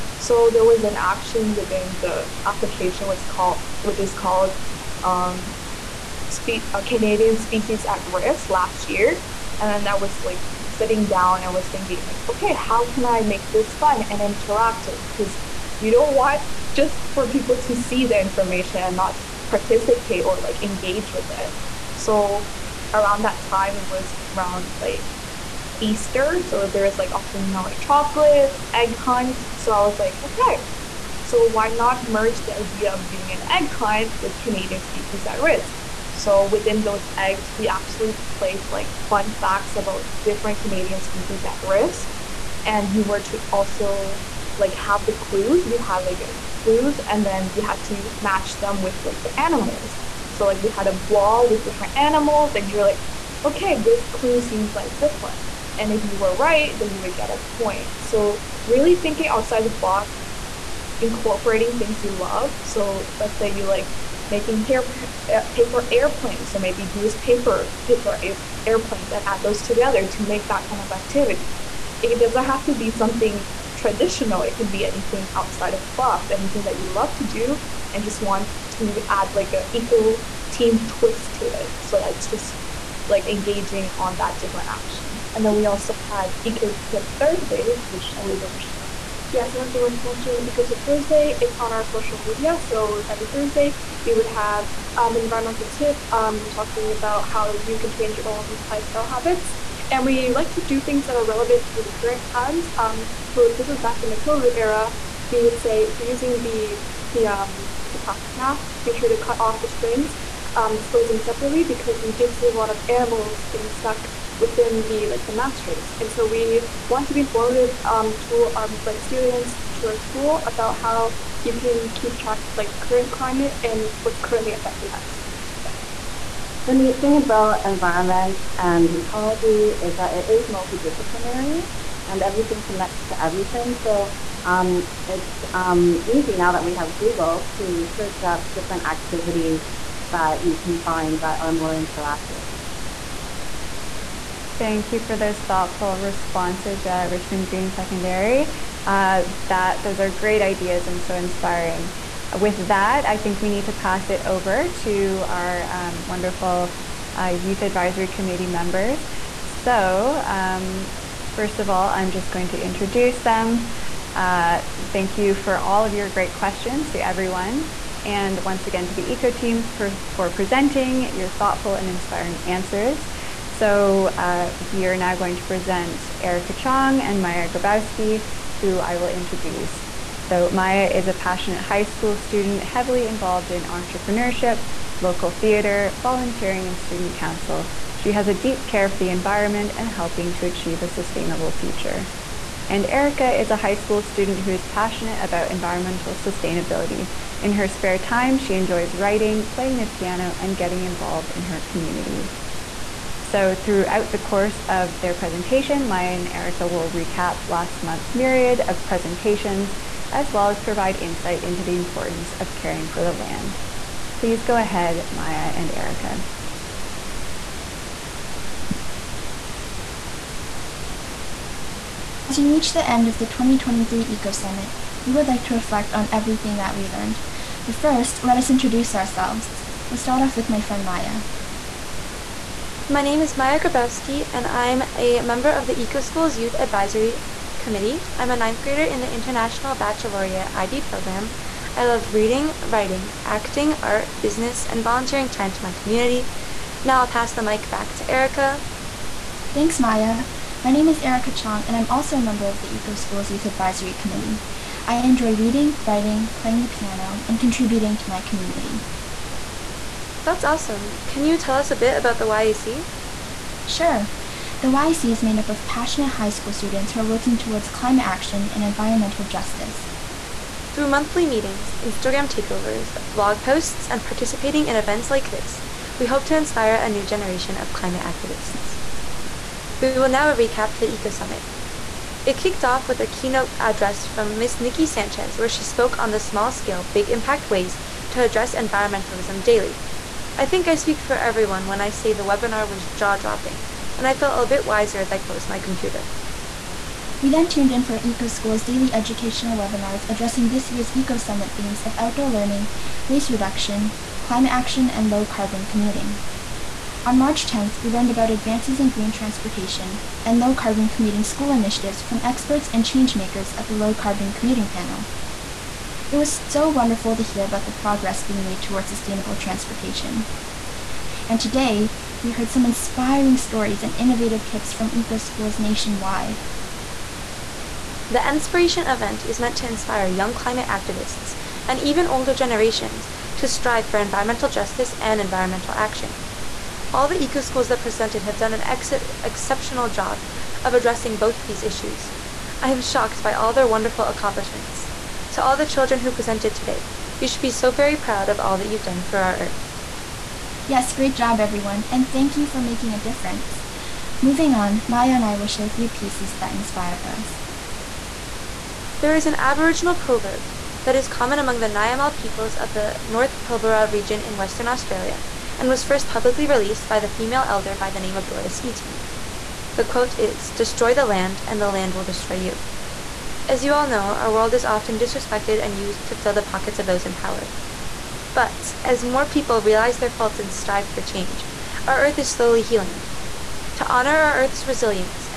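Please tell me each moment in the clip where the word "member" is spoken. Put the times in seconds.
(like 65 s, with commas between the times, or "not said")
158 s, 235 s, 252 s.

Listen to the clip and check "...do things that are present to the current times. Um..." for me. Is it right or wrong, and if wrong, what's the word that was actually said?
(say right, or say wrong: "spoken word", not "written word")
wrong: "relevant", not "present".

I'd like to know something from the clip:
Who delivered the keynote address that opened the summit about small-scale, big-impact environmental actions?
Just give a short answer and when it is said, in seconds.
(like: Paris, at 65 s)
Nikki Sanchez, at 284 s.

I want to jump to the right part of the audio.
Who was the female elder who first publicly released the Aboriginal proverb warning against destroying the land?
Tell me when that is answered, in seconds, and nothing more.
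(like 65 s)
368 s.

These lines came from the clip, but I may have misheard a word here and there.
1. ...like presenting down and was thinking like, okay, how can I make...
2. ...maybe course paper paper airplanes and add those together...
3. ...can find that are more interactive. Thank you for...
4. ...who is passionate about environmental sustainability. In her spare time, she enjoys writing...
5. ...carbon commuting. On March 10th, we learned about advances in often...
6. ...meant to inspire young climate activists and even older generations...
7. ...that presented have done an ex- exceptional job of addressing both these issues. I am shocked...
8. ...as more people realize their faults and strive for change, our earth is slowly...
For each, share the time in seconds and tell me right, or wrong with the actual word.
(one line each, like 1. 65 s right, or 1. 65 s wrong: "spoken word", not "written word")
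1. 10 s wrong: "sitting", not "presenting"
2. 66 s wrong: "goose", not "course"
3. 140 s right
4. 194 s right
5. 305 s wrong: "green", not "often"
6. 329 s right
7. 337 s right
8. 378 s right.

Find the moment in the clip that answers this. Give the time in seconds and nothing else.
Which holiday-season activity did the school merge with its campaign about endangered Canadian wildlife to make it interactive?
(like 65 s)
33 s.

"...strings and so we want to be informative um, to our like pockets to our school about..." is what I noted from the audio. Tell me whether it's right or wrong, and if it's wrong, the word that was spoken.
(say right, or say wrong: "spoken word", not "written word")
wrong: "students", not "pockets".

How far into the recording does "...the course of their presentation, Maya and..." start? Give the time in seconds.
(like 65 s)
204 s.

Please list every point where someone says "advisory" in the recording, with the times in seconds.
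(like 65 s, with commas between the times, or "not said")
157 s, 236 s, 253 s.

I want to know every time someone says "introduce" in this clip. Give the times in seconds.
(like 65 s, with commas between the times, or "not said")
162 s, 179 s, 228 s.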